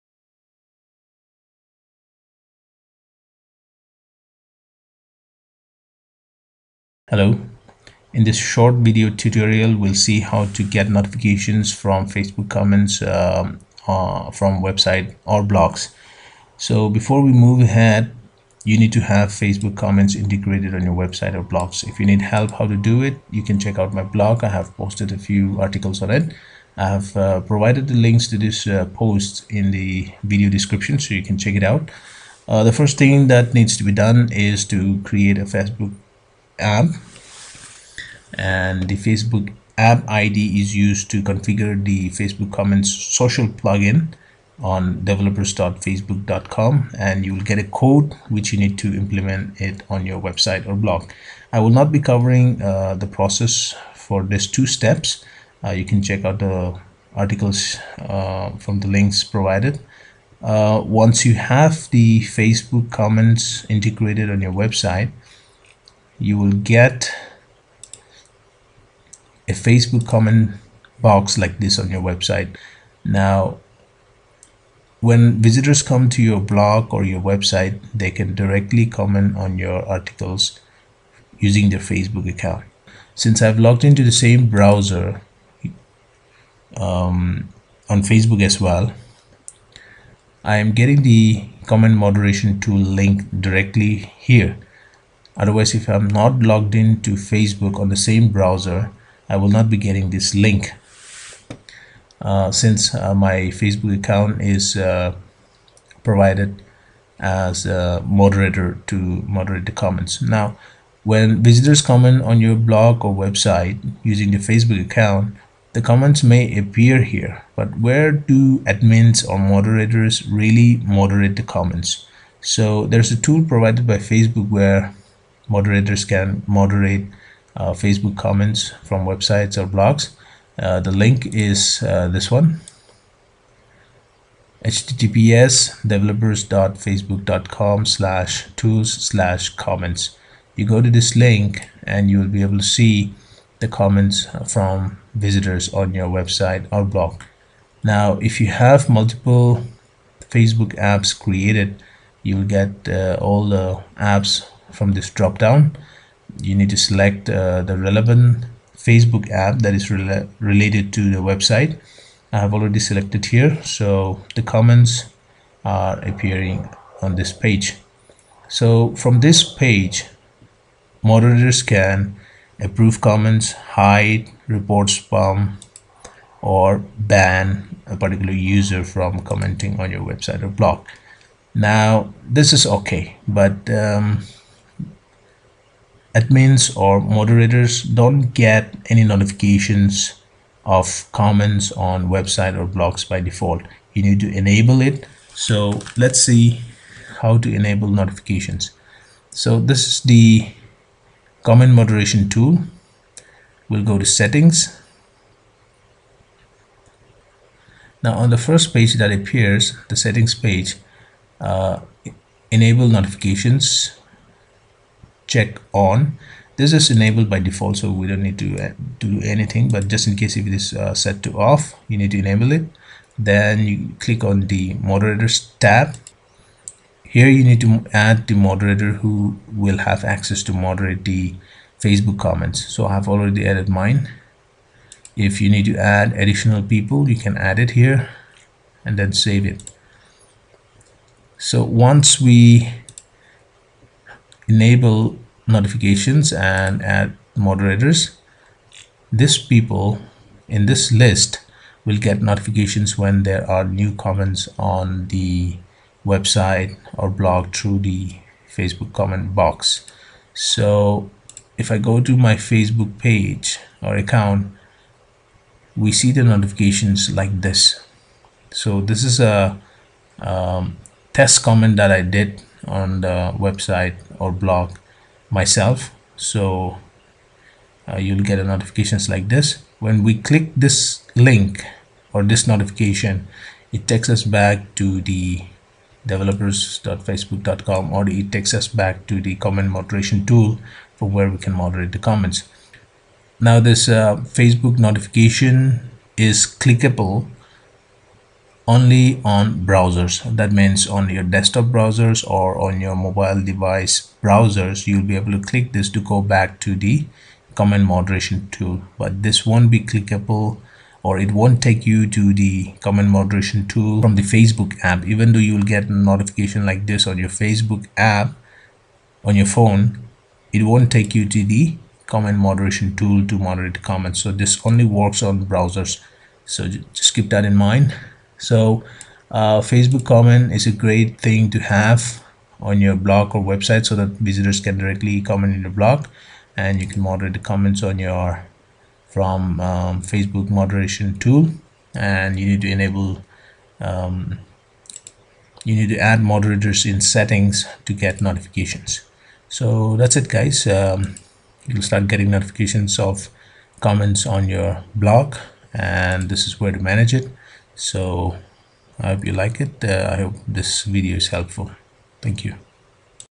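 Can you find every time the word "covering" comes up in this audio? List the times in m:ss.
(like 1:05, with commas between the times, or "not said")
0:51.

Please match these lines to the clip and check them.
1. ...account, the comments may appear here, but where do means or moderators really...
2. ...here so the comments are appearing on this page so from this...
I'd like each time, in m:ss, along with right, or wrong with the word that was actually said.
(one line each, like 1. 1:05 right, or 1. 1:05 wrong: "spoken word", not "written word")
1. 1:54 wrong: "admins", not "means"
2. 2:43 right.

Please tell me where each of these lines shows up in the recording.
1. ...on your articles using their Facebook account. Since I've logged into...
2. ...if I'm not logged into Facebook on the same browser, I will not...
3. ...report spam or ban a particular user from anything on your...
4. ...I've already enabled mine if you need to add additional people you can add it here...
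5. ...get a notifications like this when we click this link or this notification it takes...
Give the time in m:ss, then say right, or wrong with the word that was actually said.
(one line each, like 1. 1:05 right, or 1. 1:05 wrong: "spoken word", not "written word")
1. 1:19 right
2. 1:35 right
3. 2:54 wrong: "commenting", not "anything"
4. 3:52 wrong: "added", not "enabled"
5. 4:38 right.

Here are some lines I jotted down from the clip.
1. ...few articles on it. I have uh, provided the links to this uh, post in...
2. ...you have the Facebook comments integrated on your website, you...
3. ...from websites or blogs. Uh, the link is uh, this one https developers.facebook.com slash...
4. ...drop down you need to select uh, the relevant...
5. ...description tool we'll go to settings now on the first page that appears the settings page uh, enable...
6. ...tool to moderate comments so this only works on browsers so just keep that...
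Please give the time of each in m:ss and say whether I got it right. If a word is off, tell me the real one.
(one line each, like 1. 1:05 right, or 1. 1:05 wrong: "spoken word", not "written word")
1. 0:25 right
2. 1:01 right
3. 2:08 right
4. 2:35 right
5. 3:21 wrong: "moderation", not "description"
6. 5:22 right.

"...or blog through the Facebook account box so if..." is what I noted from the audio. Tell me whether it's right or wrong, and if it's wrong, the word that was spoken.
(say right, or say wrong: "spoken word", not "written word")
wrong: "comment", not "account".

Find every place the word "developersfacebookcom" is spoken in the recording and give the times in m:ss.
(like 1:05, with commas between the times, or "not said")
0:45, 2:15, 4:46.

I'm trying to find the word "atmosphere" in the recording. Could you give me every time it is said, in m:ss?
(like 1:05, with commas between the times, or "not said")
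not said.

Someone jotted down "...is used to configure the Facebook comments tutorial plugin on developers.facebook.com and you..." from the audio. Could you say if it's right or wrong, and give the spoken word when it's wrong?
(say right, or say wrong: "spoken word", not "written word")
wrong: "social", not "tutorial".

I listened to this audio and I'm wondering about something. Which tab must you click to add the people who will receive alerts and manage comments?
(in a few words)
moderators tab.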